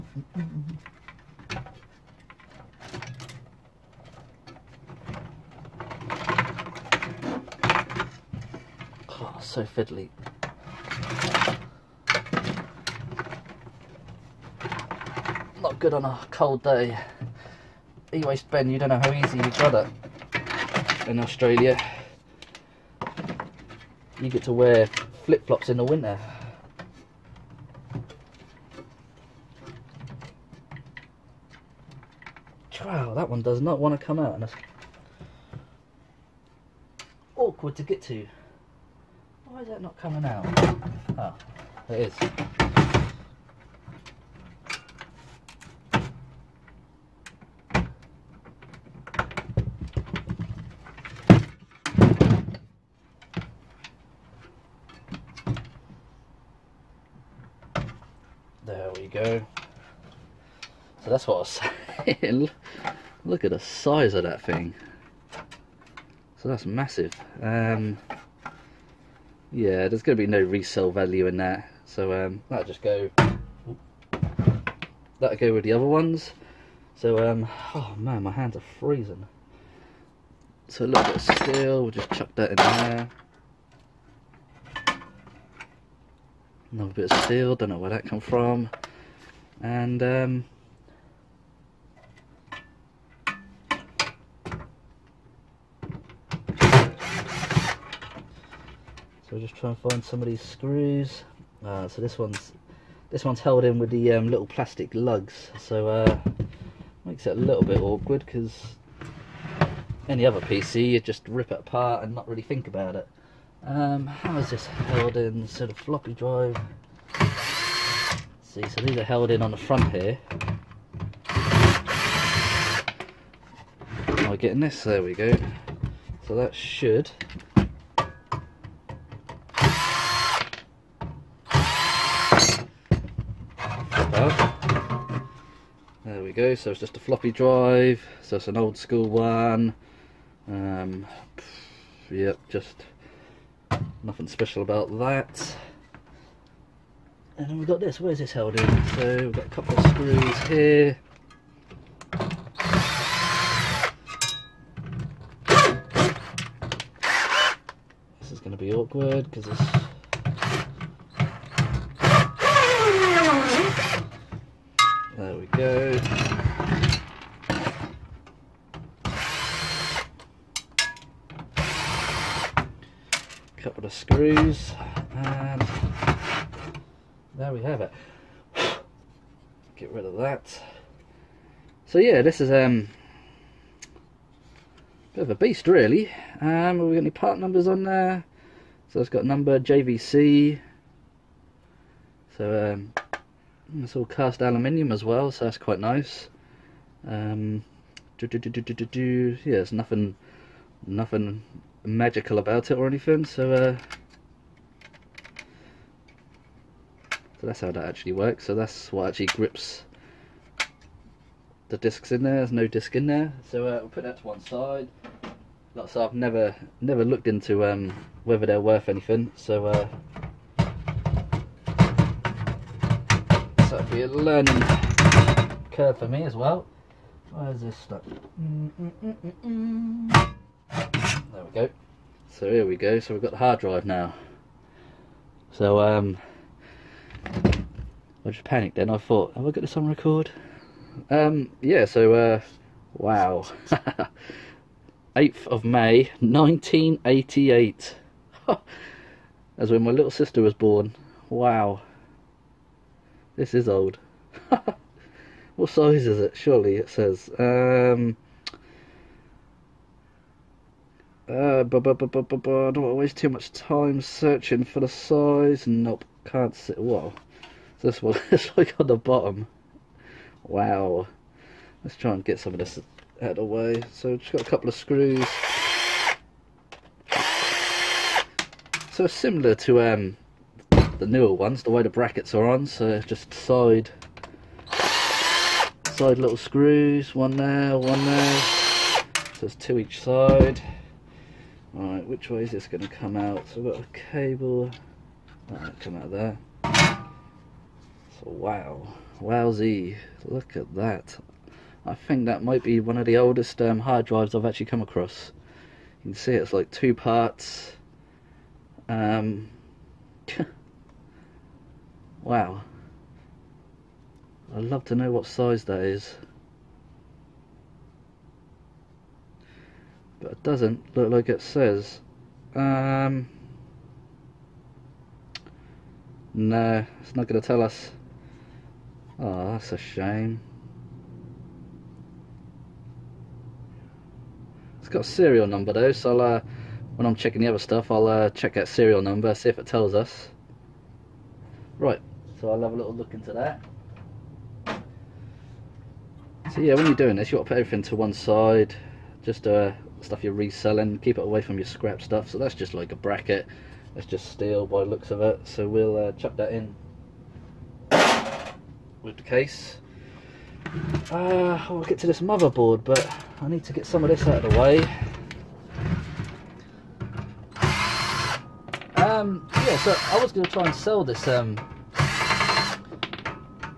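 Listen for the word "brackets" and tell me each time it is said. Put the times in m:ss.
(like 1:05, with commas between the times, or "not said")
4:41, 5:52.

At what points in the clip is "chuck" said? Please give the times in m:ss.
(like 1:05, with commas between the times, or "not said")
1:22, 5:56.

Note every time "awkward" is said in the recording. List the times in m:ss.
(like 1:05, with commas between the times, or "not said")
0:37, 1:47, 2:38.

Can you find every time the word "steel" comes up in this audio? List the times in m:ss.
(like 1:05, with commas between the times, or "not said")
1:21, 1:27, 5:54.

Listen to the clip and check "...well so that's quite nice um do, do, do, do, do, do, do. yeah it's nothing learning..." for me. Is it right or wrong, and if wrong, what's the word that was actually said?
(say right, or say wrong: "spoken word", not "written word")
wrong: "nothing", not "learning".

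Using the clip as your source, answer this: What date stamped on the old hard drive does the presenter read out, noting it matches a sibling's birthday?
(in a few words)
8th of May 1988.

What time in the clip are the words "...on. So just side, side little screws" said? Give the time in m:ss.
4:42.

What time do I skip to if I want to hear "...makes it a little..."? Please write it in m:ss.
1:47.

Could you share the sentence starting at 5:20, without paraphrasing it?
but it doesn't look like it says.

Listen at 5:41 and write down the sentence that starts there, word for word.
Right, so I'll have a little look into that.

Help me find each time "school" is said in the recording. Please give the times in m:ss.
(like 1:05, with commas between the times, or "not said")
2:18.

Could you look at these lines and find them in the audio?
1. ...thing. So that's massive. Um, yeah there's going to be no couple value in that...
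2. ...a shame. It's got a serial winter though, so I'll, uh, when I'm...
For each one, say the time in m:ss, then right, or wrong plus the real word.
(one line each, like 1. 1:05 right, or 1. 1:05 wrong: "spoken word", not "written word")
1. 1:04 wrong: "resale", not "couple"
2. 5:29 wrong: "number", not "winter".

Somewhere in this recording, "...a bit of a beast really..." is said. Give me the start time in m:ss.
3:04.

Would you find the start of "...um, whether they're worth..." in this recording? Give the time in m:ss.
3:37.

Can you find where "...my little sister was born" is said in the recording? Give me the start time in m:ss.
4:09.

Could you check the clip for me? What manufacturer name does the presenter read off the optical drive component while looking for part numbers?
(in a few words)
JVC.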